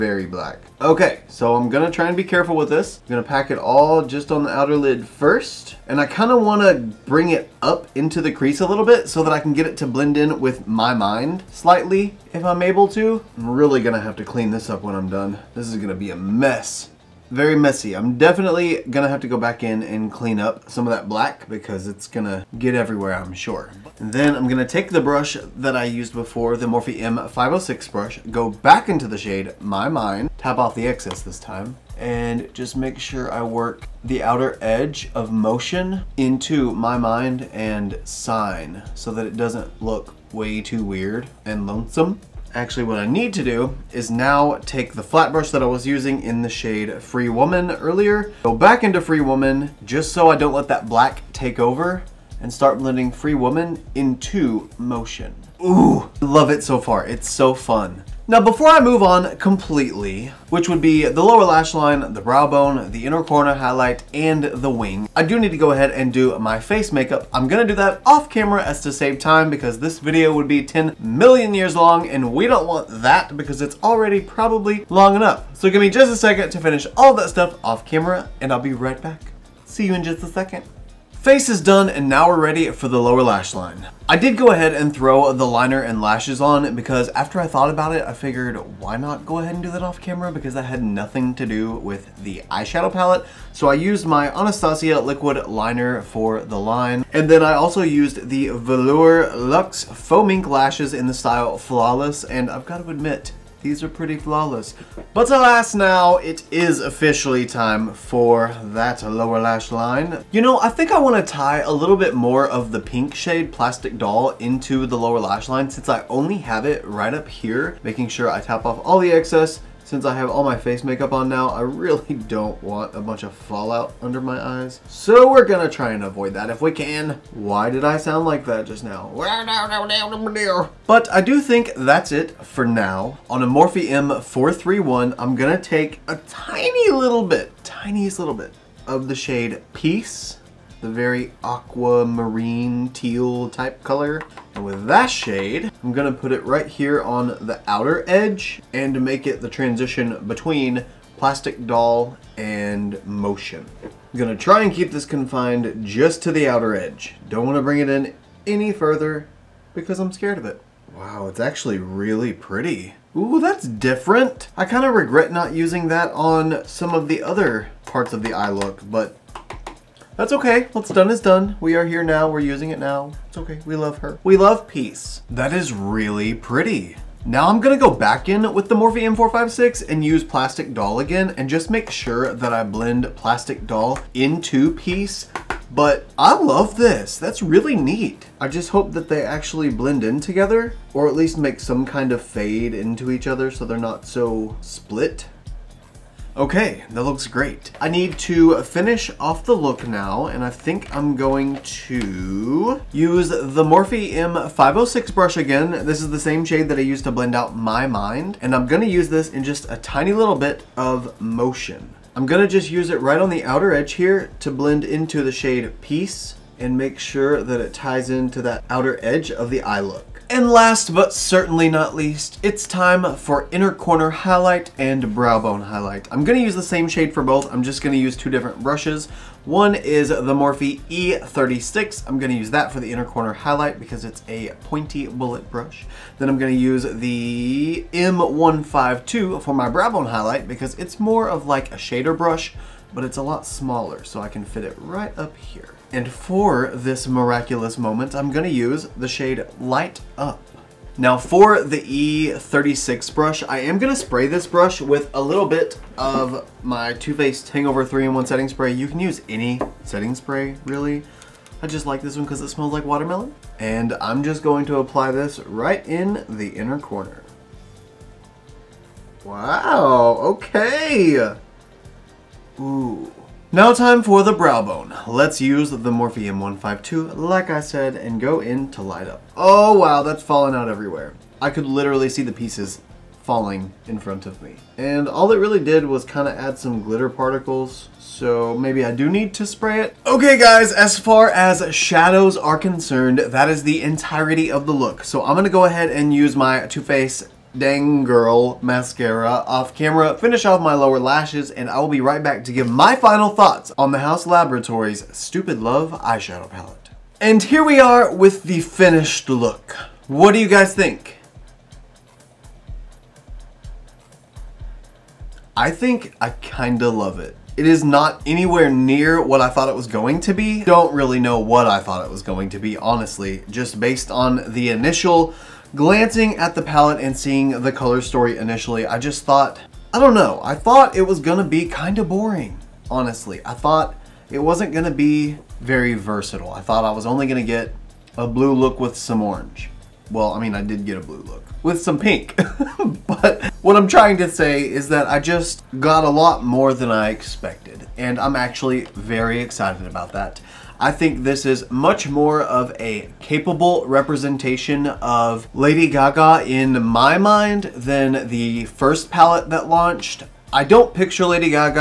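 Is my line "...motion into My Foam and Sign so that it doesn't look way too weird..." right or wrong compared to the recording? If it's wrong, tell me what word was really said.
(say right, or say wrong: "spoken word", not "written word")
wrong: "Mind", not "Foam".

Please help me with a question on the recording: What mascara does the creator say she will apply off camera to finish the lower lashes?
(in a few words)
Too Faced Dang Girl.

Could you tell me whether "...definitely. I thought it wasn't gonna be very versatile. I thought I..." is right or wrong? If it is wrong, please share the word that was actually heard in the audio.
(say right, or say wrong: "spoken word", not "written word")
wrong: "honestly", not "definitely".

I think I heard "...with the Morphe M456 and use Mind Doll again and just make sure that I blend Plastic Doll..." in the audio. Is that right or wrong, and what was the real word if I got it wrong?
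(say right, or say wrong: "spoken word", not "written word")
wrong: "Plastic", not "Mind".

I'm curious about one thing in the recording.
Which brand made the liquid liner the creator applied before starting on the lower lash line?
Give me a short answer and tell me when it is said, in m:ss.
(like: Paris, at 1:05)
Anastasia, at 1:34.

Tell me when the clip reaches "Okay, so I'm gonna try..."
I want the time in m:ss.
0:00.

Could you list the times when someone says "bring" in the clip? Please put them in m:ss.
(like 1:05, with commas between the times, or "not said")
0:06, 2:37.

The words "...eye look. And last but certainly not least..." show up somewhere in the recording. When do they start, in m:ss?
3:39.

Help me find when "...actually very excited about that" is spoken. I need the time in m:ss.
5:48.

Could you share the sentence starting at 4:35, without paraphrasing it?
Let's use the m 152, like I said, and go in to light up.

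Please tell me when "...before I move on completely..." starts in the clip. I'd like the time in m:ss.
0:58.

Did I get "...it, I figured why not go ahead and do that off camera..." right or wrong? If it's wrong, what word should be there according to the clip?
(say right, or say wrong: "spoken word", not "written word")
right.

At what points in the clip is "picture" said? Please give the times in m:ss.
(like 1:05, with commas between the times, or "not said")
6:00.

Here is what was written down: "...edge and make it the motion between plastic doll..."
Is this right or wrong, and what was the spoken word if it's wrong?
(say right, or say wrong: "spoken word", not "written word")
wrong: "transition", not "motion".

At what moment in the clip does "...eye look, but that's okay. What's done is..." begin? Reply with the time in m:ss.
2:48.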